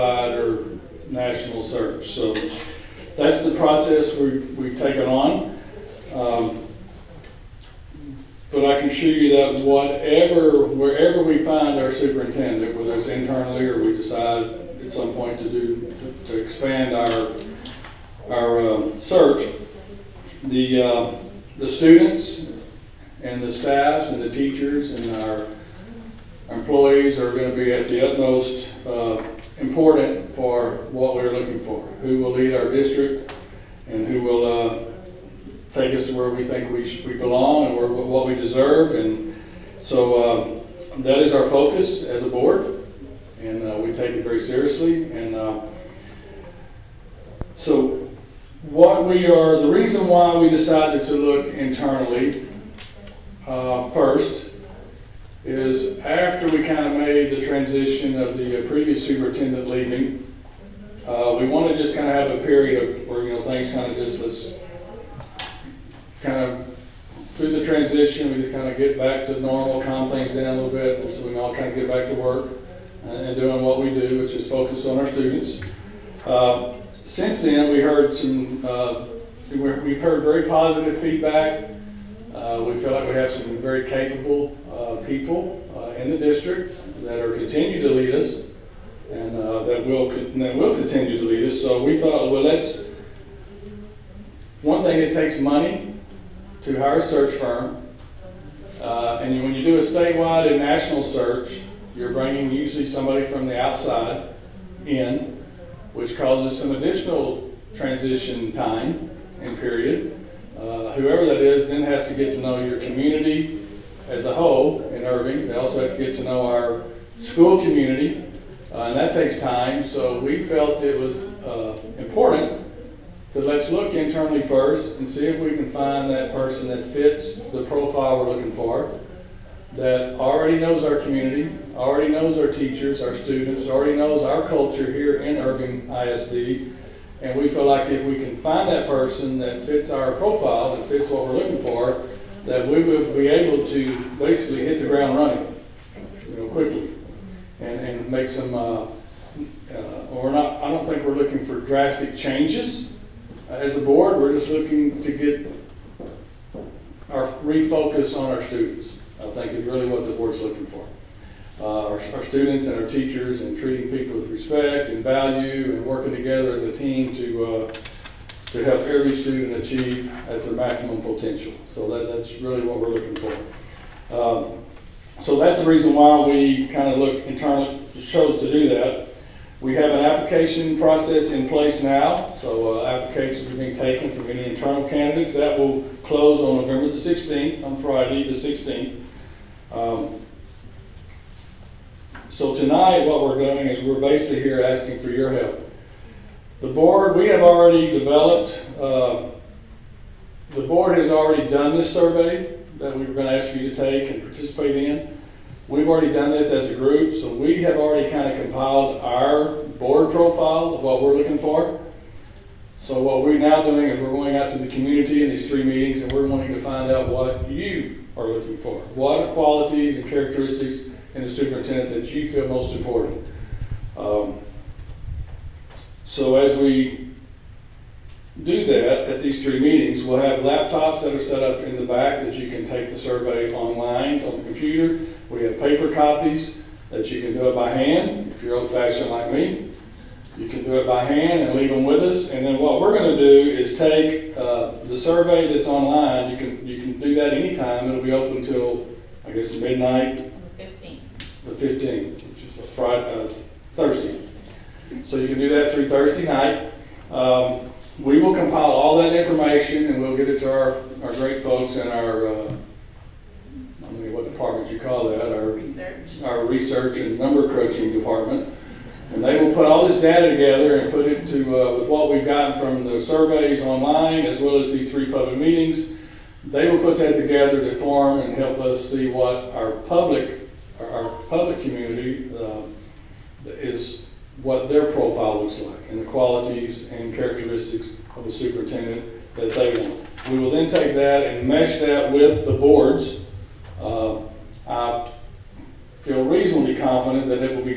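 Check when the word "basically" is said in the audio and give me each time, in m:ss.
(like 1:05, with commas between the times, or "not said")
2:24, 3:14.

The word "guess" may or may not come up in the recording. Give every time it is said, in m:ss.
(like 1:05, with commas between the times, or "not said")
4:09.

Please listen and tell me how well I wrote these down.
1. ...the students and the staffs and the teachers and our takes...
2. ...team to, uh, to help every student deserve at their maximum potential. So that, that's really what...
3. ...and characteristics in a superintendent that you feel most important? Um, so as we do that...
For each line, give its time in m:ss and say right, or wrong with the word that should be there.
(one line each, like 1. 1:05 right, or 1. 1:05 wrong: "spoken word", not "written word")
1. 0:21 wrong: "employees", not "takes"
2. 2:46 wrong: "achieve", not "deserve"
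3. 3:39 right.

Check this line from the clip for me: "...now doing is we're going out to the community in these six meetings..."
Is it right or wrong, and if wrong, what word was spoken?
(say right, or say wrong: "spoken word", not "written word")
wrong: "three", not "six".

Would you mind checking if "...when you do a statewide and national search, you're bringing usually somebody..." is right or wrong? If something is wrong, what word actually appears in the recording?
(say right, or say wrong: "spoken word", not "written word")
right.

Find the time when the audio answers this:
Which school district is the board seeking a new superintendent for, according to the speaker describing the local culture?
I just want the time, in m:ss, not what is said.
2:15.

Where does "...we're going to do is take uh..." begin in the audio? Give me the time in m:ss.
4:02.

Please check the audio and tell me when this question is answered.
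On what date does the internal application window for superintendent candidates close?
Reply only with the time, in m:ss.
3:06.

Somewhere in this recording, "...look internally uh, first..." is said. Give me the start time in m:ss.
0:51.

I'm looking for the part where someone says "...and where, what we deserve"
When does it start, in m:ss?
0:37.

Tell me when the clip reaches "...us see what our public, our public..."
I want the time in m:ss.
4:38.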